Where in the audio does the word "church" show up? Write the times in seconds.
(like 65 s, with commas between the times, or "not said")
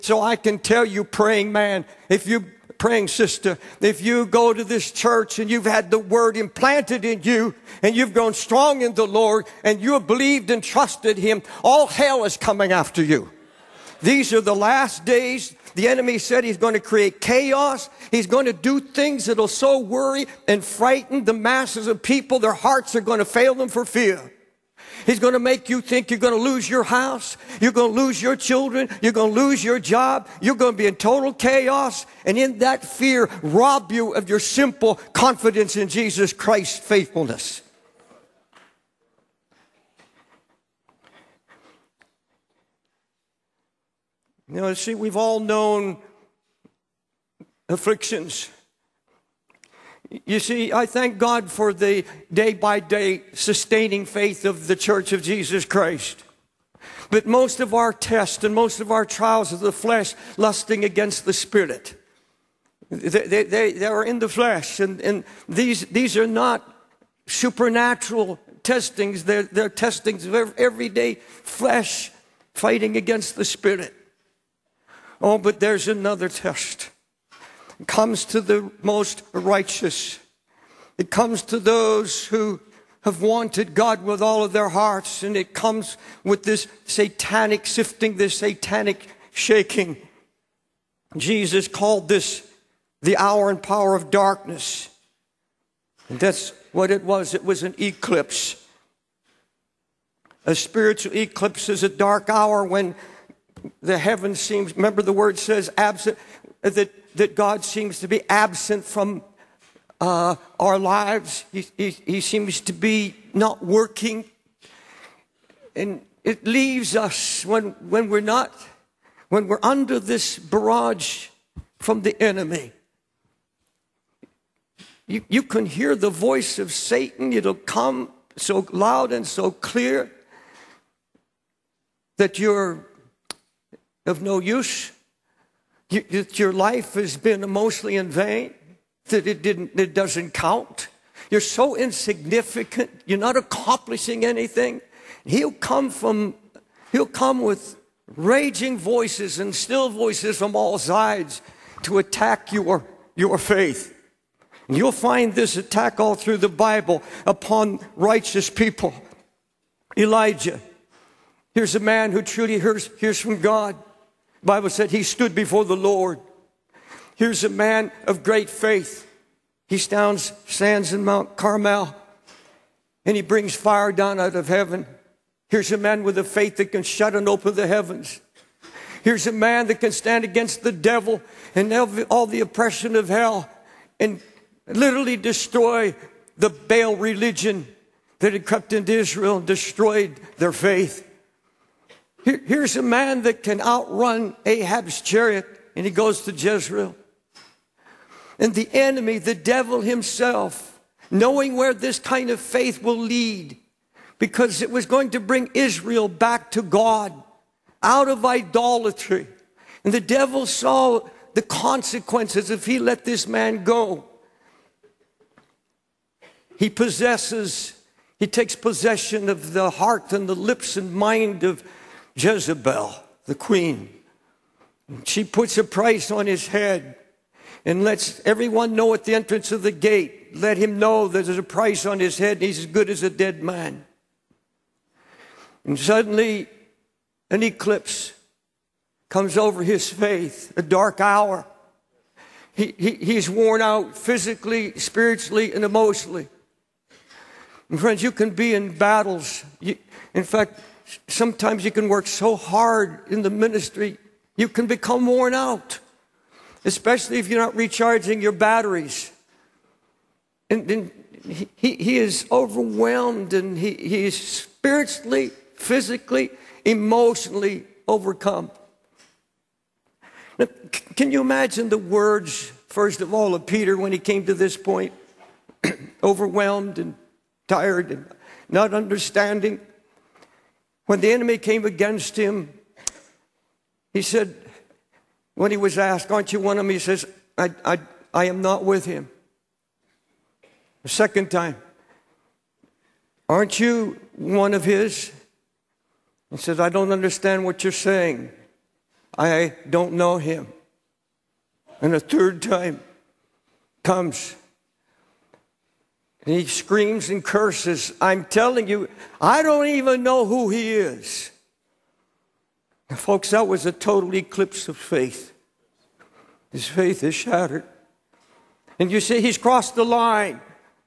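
4 s, 54 s.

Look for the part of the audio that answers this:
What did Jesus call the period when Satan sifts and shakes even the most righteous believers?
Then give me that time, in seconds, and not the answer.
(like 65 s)
93 s.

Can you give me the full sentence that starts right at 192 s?
Here, here's a man that can outrun Ahab's chariot, and he goes to Jezreel.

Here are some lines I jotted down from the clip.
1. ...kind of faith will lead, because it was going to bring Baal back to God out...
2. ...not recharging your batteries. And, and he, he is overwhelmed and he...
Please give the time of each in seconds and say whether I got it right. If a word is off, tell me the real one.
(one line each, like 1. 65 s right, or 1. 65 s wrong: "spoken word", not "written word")
1. 201 s wrong: "Israel", not "Baal"
2. 257 s right.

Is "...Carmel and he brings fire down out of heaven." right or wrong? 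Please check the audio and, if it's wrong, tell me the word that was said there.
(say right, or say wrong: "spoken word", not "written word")
right.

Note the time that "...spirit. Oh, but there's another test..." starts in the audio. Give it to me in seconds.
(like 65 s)
73 s.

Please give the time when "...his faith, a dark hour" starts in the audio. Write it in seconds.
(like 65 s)
239 s.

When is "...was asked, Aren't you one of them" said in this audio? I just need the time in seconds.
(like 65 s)
285 s.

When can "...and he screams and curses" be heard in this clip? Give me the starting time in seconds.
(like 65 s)
306 s.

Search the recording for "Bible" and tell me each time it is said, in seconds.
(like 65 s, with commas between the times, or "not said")
156 s, 164 s.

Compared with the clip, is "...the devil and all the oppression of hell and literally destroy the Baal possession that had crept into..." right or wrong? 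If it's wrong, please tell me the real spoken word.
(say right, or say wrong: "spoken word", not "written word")
wrong: "religion", not "possession".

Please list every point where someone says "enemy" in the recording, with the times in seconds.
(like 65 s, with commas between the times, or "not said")
15 s, 122 s, 198 s, 281 s.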